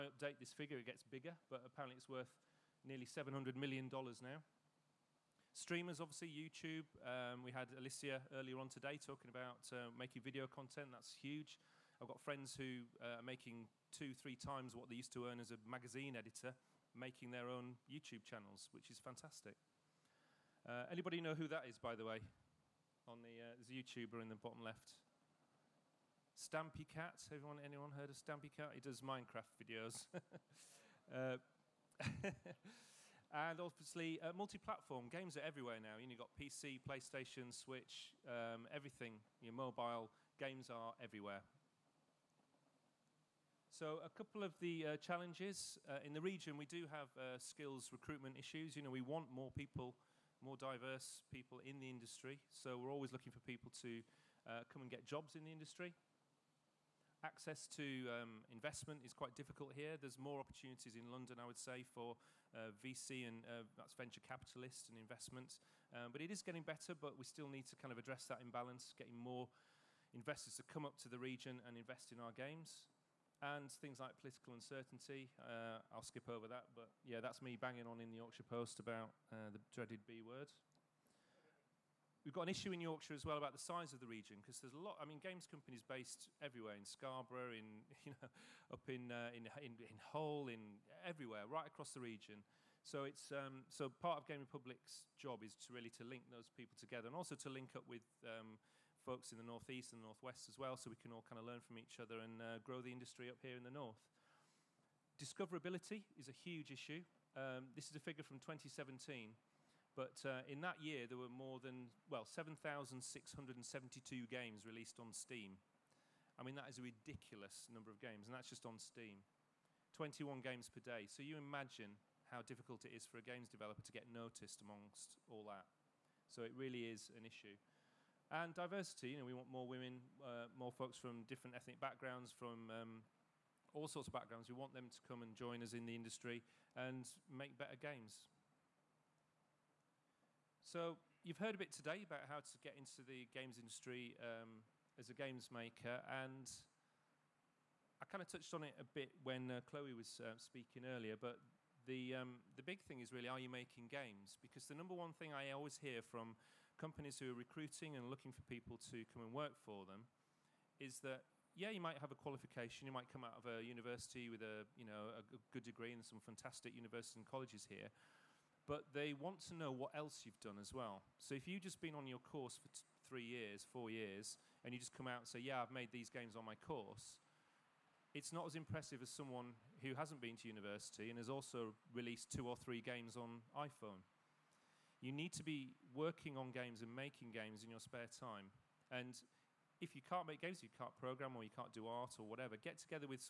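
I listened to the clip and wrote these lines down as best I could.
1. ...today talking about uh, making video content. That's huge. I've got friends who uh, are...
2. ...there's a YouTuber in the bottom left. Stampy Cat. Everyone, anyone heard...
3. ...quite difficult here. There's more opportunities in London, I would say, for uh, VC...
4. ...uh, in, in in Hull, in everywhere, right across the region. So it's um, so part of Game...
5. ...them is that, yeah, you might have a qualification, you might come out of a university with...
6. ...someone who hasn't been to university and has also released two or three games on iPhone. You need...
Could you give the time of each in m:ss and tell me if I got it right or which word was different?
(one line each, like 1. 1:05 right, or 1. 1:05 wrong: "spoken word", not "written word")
1. 0:08 right
2. 0:23 right
3. 0:59 right
4. 1:29 right
5. 2:39 right
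6. 2:59 right.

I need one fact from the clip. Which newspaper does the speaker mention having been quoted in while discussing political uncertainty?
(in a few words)
Yorkshire Post.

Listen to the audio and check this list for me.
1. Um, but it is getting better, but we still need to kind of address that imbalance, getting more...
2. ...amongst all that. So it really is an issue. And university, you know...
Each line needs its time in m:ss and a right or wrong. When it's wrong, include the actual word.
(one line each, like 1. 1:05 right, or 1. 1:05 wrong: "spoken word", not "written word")
1. 1:05 right
2. 2:04 wrong: "diversity", not "university".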